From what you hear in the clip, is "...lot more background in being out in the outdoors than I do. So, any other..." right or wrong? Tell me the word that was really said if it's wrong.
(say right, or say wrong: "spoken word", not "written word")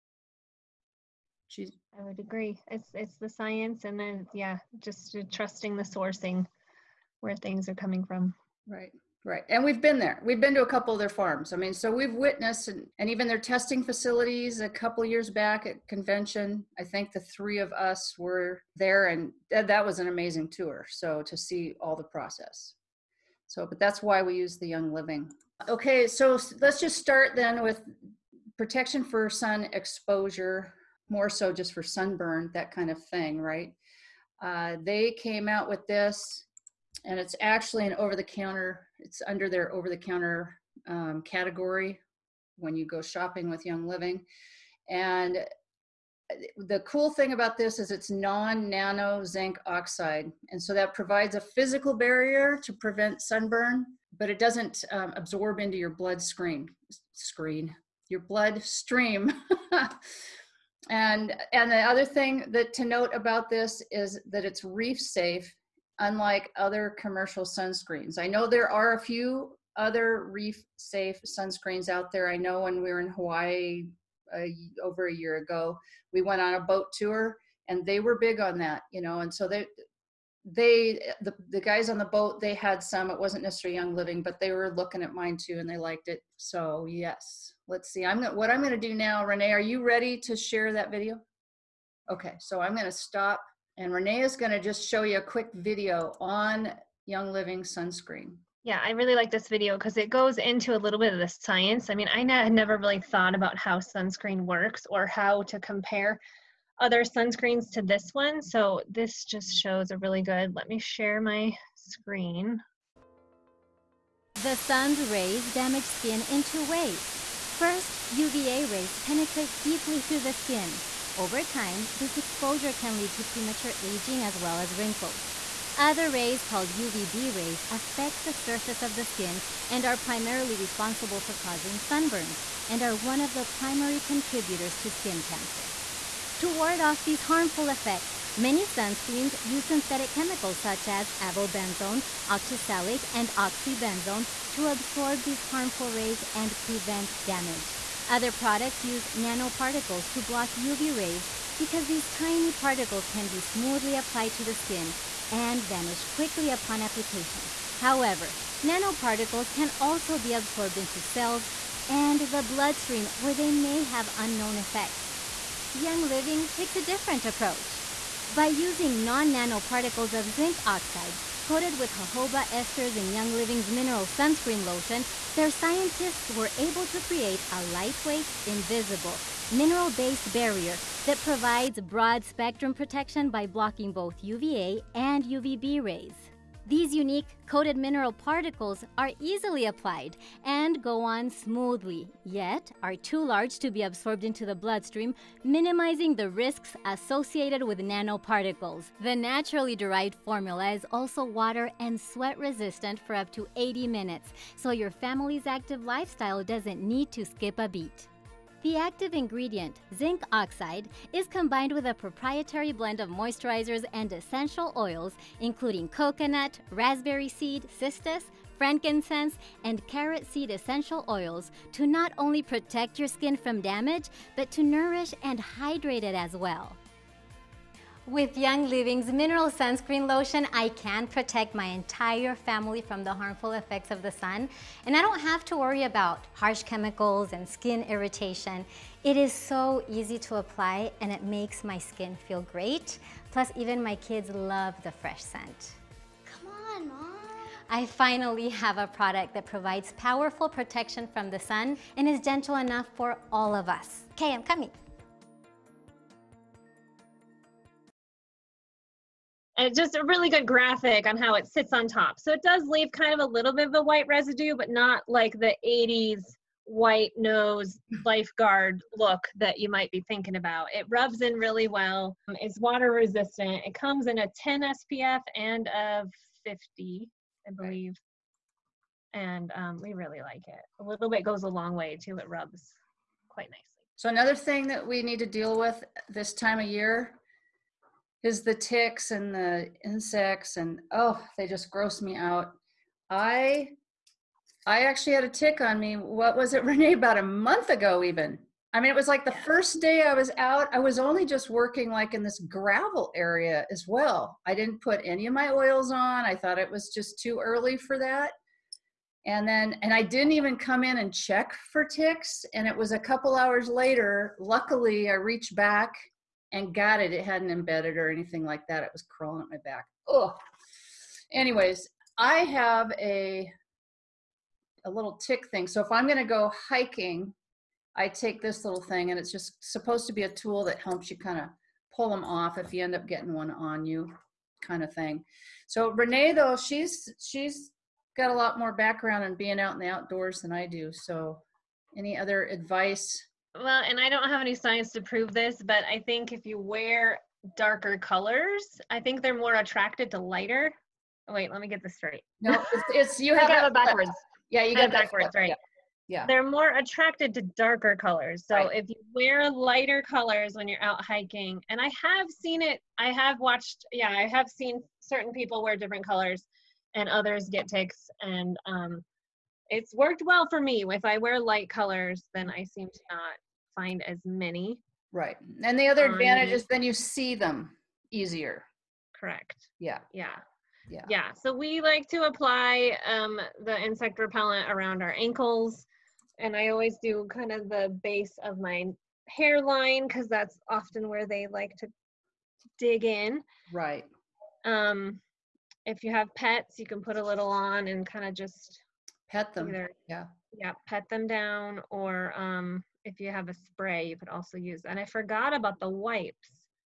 right.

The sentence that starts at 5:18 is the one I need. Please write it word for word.
It was crawling at my back.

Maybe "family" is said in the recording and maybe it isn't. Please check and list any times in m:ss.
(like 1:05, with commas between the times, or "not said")
3:24, 3:52.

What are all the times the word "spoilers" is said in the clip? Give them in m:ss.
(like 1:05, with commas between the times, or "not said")
not said.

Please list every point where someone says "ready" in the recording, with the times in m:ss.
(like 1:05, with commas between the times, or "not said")
1:29.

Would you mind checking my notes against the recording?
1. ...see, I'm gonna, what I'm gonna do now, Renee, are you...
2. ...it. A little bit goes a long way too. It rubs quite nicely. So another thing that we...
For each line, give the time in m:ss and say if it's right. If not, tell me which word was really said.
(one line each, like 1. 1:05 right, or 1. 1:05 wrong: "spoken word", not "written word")
1. 1:27 right
2. 4:40 right.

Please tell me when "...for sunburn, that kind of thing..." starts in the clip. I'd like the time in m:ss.
0:31.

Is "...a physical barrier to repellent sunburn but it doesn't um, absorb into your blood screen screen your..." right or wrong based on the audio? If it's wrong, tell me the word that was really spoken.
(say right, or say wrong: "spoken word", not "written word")
wrong: "prevent", not "repellent".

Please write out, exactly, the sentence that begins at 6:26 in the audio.
And I always do kind of the base of my hairline because that's often where they like to dig in.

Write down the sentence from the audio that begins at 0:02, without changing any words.
It's it's the science and then yeah, just trusting the sourcing where things are coming from.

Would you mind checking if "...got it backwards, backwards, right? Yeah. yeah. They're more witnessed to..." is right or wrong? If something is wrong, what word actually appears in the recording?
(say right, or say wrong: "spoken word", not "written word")
wrong: "attracted", not "witnessed".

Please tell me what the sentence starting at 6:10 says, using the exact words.
If I wear light colors, then I seem to not find as many.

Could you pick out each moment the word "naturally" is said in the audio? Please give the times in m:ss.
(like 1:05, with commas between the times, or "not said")
3:19.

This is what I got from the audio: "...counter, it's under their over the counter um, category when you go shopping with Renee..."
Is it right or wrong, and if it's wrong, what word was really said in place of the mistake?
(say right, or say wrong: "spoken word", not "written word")
wrong: "Young", not "Renee".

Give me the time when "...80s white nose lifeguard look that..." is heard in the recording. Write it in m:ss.
4:25.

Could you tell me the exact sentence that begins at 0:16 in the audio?
I think the three of us were there and that was an amazing tour.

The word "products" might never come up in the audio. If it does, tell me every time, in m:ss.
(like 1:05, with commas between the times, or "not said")
2:28, 4:08.